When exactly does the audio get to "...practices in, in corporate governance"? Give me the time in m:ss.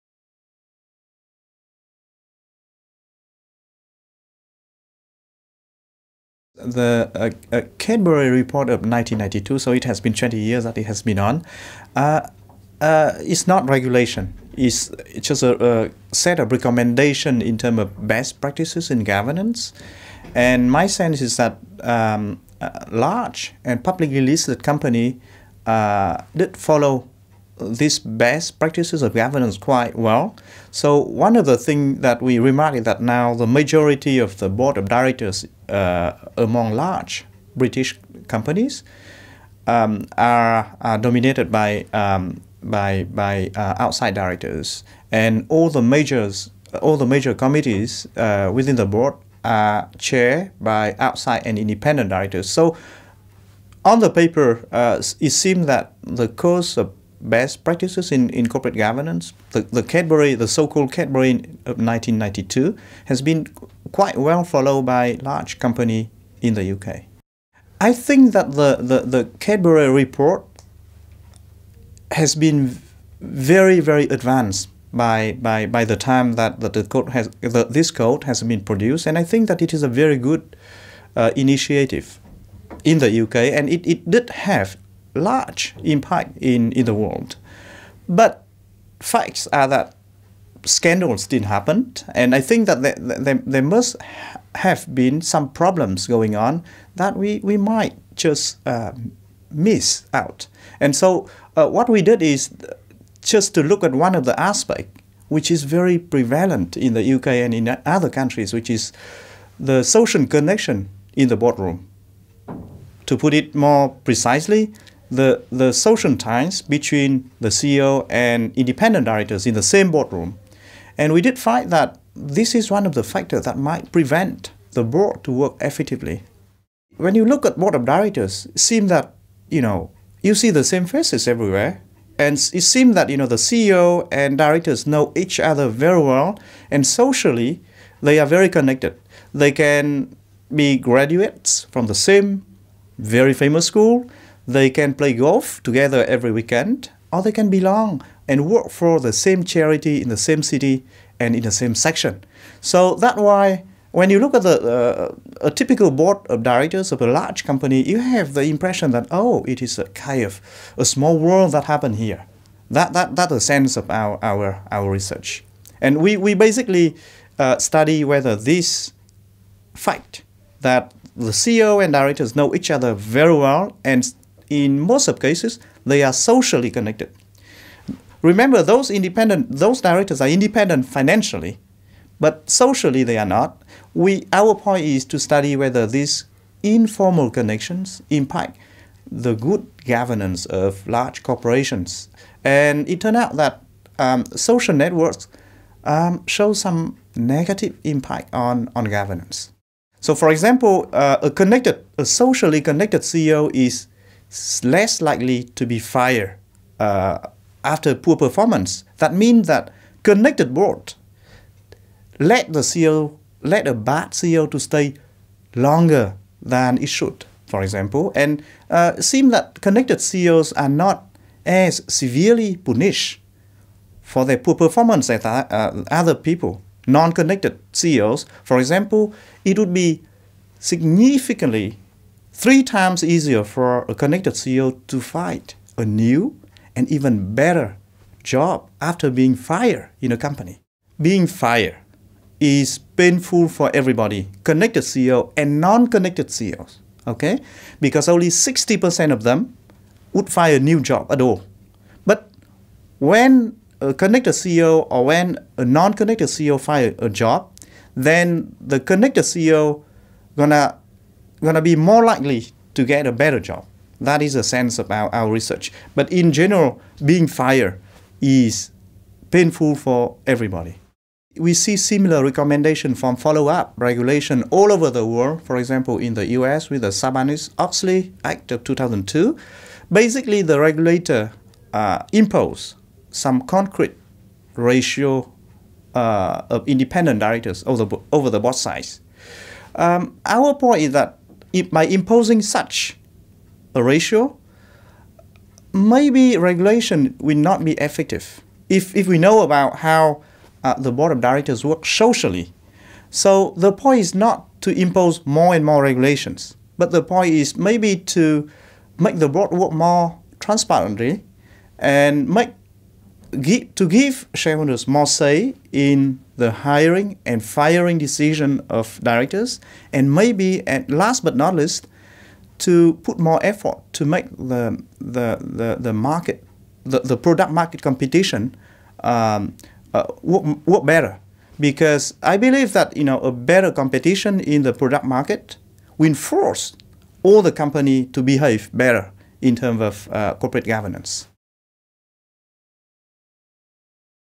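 0:57.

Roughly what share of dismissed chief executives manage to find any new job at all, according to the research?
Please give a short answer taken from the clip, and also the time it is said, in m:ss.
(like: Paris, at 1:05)
60%, at 4:08.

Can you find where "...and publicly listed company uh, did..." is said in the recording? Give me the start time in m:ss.
0:23.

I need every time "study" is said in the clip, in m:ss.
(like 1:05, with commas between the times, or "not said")
2:47, 3:05.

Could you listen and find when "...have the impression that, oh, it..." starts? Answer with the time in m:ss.
2:37.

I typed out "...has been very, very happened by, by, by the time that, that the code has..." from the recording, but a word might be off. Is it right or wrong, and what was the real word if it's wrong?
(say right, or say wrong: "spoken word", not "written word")
wrong: "advanced", not "happened".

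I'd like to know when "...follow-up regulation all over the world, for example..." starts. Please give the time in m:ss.
4:33.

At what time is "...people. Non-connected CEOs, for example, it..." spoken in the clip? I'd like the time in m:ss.
3:46.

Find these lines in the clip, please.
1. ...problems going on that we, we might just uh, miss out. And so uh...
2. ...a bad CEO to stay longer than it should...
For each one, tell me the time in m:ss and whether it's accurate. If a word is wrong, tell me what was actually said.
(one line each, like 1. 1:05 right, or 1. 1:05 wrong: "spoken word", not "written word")
1. 1:35 right
2. 3:33 right.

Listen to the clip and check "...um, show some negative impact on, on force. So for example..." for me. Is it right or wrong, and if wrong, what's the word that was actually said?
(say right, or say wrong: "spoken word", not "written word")
wrong: "governance", not "force".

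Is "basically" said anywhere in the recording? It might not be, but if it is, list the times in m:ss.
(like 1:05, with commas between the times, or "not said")
2:46, 4:39.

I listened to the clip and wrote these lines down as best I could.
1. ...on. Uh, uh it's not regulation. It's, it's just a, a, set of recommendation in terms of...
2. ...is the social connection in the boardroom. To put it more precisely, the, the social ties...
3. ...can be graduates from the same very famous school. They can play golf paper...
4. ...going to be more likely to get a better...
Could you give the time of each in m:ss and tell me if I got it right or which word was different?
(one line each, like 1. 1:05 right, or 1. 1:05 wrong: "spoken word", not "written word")
1. 0:11 right
2. 1:48 right
3. 2:19 wrong: "together", not "paper"
4. 4:21 right.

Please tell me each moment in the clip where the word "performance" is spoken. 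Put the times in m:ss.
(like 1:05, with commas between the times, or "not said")
3:28, 3:44.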